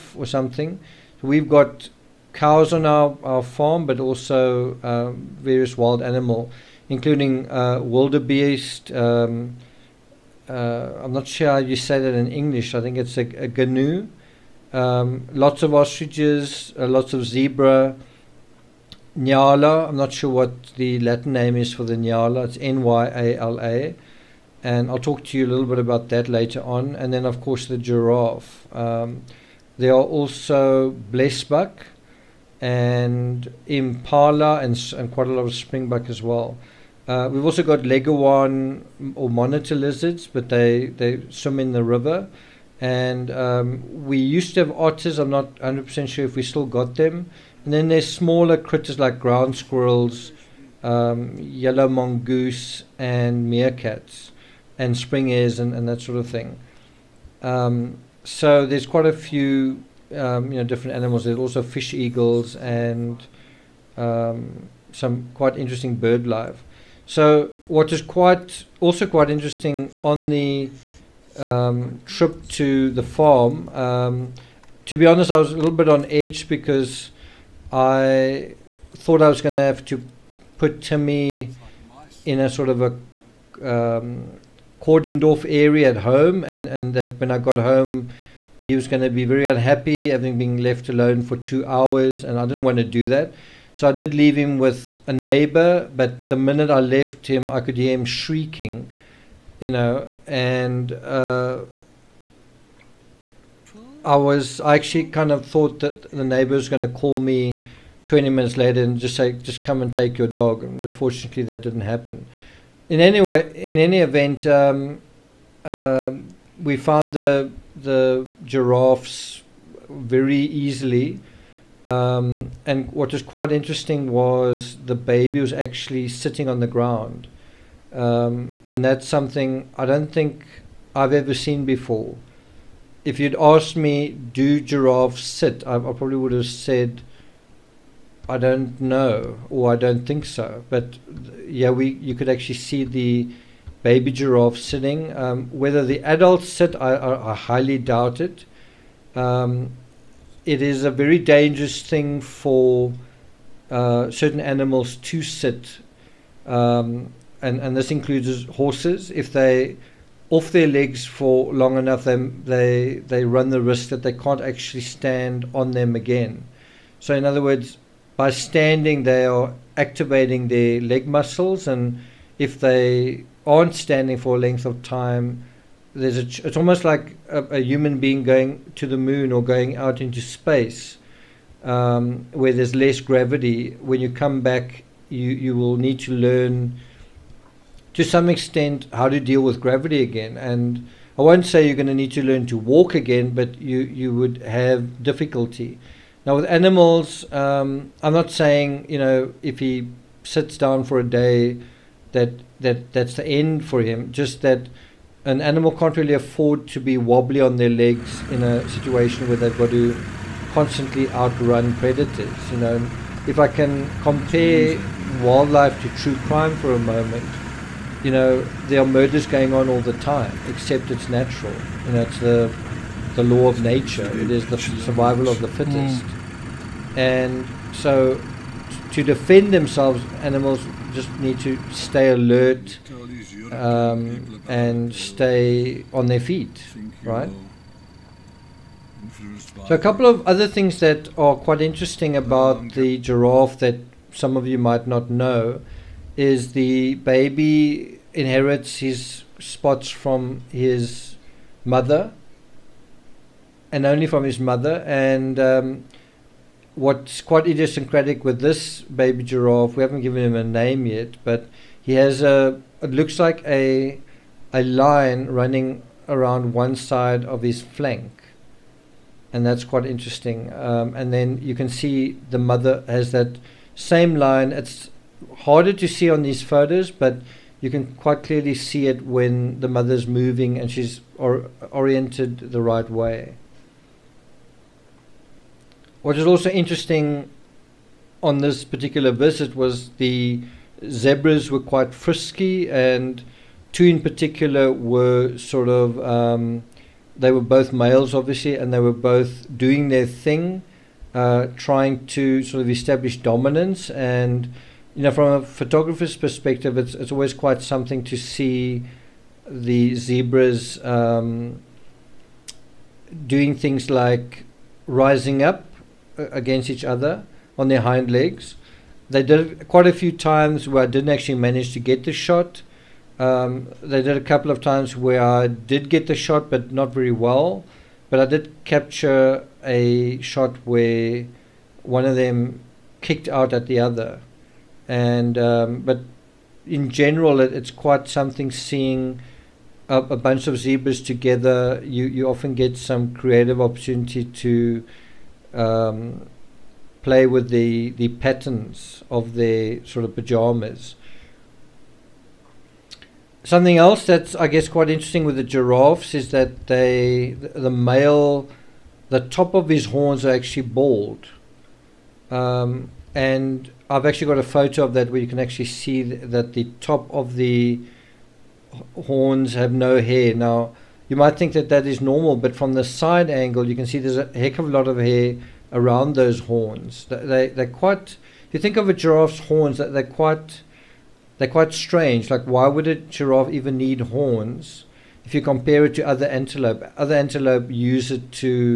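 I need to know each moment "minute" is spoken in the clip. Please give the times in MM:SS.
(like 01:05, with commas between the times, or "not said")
01:36, 01:48.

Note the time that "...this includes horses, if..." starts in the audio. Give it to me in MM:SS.
02:37.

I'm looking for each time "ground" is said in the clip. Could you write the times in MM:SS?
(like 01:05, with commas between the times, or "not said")
00:49, 02:06.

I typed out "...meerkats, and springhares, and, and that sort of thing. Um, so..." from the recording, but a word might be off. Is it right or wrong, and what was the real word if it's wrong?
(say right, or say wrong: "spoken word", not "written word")
right.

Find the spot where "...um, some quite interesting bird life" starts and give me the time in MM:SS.
01:03.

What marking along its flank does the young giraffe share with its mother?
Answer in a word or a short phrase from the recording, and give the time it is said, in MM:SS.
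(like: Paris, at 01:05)
A line, at 04:24.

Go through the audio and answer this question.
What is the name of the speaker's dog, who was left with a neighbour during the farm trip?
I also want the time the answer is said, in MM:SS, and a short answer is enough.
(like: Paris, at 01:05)
Timmy, at 01:20.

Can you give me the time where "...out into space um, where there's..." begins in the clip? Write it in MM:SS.
02:59.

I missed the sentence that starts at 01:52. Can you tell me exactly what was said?
In any way, in any event, um, uh, we found the the giraffes very easily.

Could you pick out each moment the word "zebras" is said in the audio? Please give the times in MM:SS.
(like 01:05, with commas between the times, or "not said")
00:17, 04:50, 05:09, 05:40.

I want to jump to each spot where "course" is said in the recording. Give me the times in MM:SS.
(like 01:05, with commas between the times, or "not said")
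00:27.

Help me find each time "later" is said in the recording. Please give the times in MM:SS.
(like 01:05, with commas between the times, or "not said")
00:26, 01:48.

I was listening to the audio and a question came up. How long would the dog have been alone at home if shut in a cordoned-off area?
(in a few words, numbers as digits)
2 hours.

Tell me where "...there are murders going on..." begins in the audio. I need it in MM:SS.
03:38.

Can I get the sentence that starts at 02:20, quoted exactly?
But yeah, we you could actually see the baby giraffe sitting.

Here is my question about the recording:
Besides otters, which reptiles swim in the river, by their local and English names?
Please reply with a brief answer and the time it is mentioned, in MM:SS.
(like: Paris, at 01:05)
Leguan or monitor lizards, at 00:37.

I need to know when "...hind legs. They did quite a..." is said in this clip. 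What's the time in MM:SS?
05:17.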